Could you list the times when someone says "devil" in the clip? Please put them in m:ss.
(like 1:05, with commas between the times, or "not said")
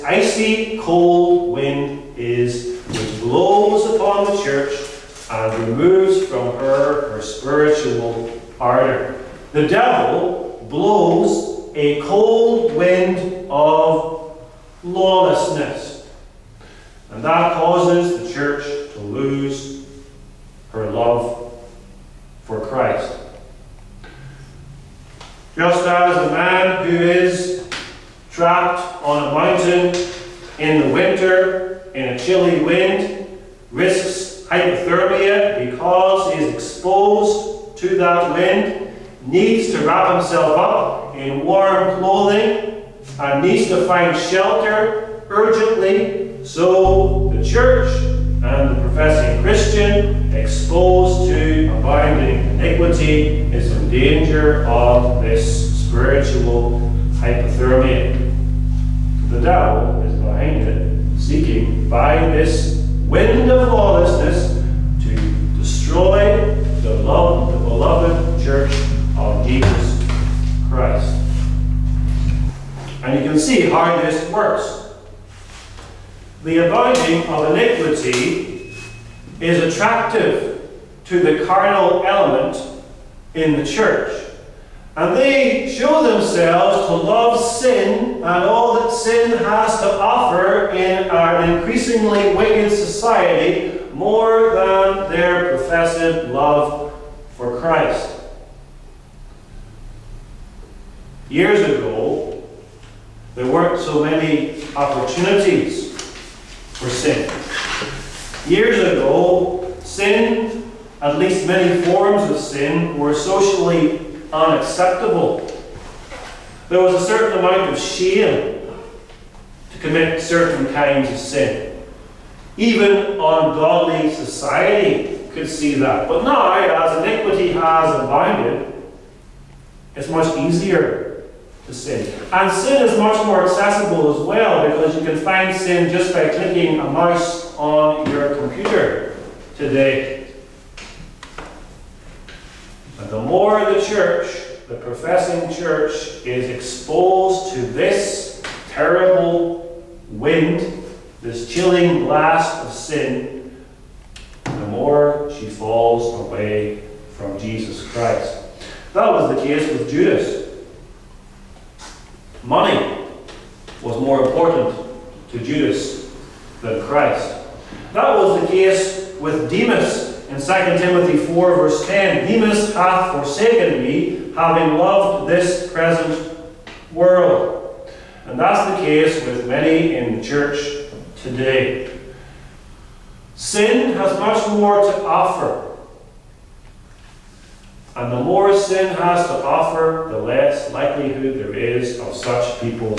0:09, 0:59.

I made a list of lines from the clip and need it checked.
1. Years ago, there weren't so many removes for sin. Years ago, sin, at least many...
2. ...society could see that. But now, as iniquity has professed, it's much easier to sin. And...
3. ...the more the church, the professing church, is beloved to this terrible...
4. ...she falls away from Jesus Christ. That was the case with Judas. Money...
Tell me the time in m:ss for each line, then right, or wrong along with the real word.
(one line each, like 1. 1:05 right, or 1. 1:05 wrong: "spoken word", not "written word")
1. 1:41 wrong: "opportunities", not "removes"
2. 2:04 wrong: "abounded", not "professed"
3. 2:23 wrong: "exposed", not "beloved"
4. 2:35 right.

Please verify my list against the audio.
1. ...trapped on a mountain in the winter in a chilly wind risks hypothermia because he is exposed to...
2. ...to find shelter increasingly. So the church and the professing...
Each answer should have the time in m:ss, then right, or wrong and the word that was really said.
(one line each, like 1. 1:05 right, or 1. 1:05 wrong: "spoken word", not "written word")
1. 0:28 right
2. 0:43 wrong: "urgently", not "increasingly".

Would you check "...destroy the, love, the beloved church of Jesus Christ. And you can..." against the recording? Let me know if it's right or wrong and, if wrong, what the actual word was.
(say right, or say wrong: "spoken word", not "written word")
right.